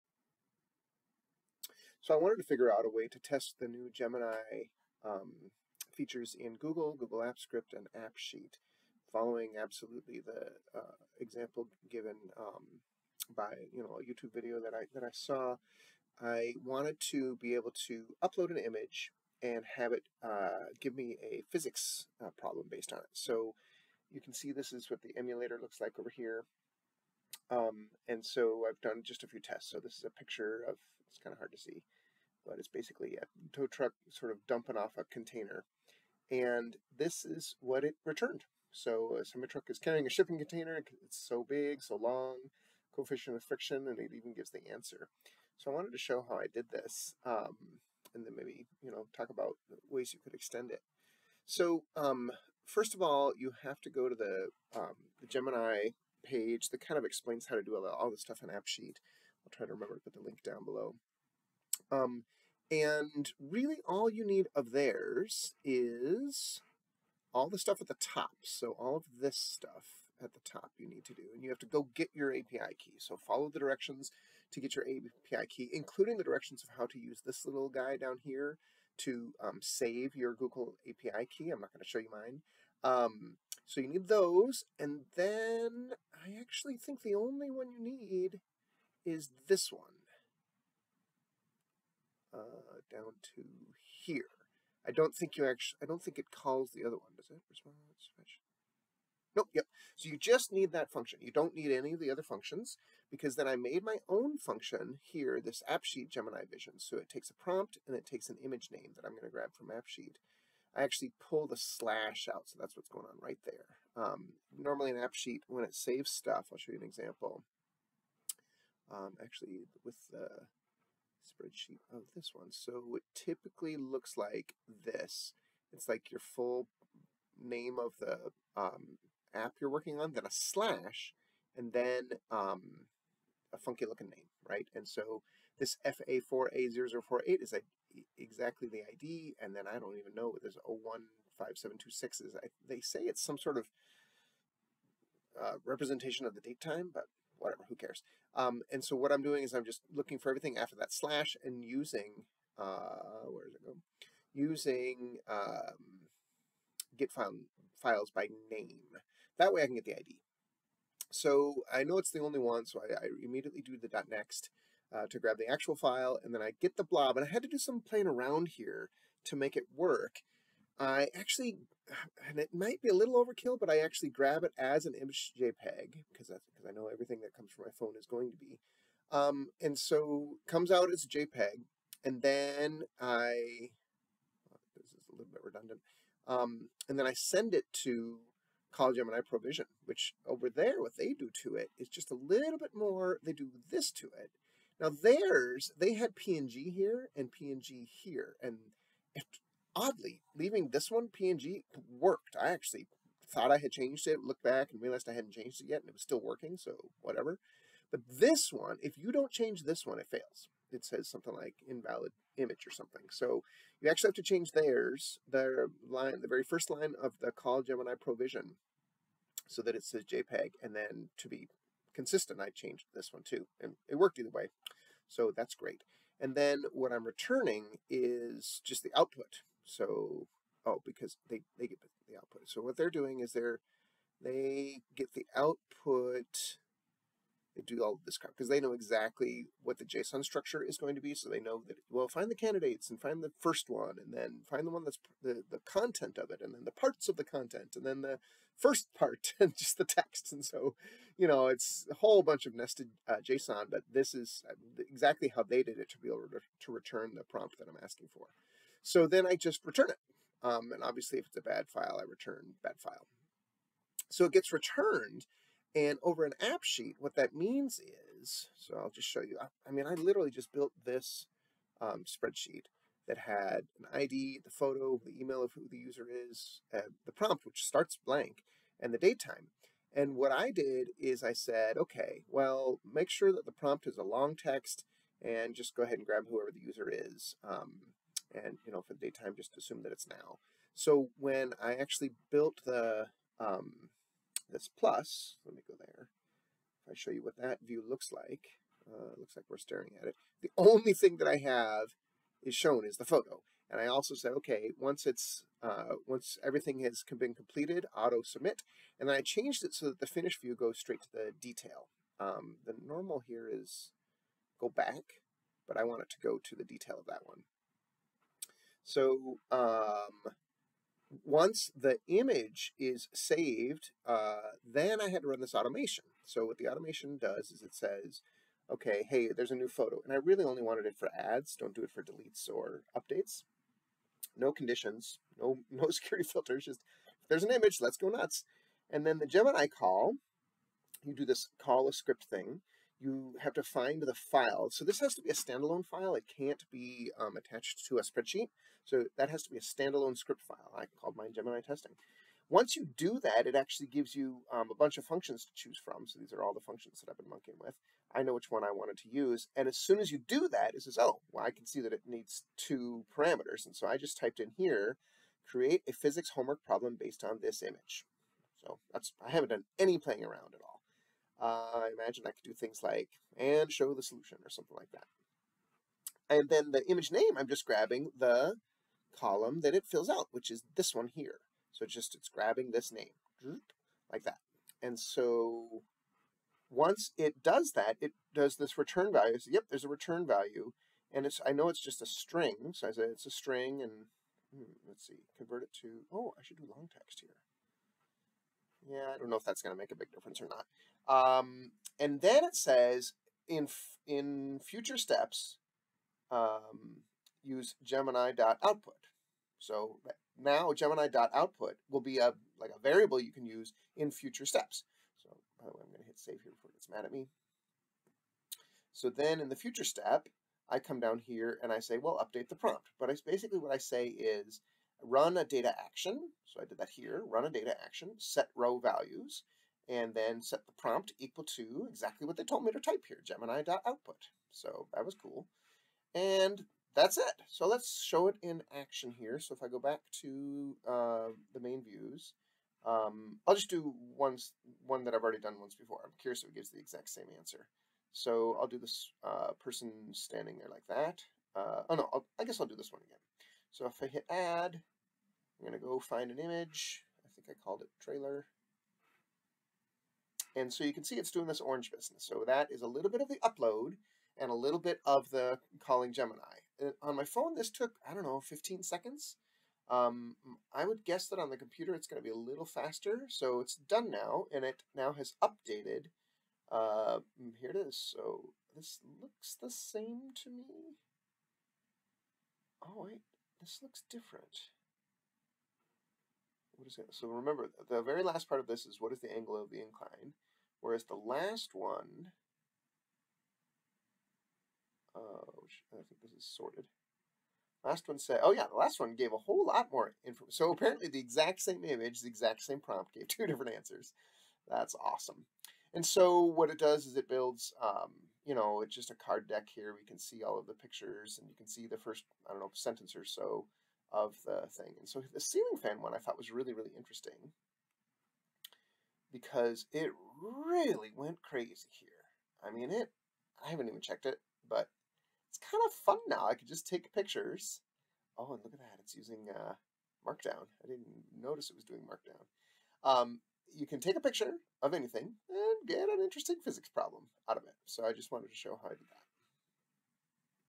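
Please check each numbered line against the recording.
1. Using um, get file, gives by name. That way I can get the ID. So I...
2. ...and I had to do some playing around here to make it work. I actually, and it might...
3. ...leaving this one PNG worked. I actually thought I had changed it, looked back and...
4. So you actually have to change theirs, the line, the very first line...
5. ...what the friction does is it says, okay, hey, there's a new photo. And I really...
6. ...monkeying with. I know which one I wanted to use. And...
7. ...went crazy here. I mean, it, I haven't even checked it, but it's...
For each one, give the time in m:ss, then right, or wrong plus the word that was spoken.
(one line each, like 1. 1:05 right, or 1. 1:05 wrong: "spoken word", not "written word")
1. 2:34 wrong: "files", not "gives"
2. 2:47 right
3. 3:20 right
4. 3:33 right
5. 5:26 wrong: "automation", not "friction"
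6. 5:57 right
7. 8:41 right.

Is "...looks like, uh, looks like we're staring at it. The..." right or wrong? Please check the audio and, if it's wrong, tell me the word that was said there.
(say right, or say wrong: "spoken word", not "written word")
right.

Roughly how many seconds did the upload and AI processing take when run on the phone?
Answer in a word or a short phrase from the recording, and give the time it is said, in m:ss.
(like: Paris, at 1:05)
15 seconds, at 7:48.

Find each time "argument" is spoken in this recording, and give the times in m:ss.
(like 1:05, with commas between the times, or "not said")
not said.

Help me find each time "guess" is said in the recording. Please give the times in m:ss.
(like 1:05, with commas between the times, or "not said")
7:32, 7:51.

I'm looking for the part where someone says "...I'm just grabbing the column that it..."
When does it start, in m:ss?
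6:17.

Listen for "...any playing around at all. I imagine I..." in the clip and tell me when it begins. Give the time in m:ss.
6:09.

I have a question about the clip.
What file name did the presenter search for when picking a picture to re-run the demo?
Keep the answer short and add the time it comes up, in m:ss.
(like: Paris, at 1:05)
trailer, at 7:37.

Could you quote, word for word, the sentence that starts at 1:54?
Um, normally in AppSheet, when it saves stuff, I'll show you an example um, actually with the spreadsheet of this one.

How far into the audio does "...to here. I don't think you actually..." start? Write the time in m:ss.
1:33.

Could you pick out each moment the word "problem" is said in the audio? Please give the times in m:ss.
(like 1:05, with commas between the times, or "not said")
0:22, 6:06, 8:56.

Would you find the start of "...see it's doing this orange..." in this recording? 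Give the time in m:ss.
7:41.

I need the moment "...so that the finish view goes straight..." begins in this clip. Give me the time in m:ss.
5:09.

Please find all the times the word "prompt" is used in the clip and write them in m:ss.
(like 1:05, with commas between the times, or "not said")
1:47, 4:17, 4:37, 4:43, 7:02, 7:10, 8:22.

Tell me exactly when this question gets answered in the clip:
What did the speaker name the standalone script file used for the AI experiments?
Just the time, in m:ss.
5:51.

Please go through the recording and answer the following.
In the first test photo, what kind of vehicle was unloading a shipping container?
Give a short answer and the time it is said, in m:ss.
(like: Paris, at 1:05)
Tow truck, at 0:33.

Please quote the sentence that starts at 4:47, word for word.
Um, and you know for daytime just assume that it's now.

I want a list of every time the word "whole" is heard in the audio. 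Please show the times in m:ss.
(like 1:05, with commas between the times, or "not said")
4:11, 8:19.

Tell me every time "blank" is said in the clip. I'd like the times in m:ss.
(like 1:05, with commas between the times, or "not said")
4:38.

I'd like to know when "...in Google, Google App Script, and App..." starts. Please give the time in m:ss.
0:06.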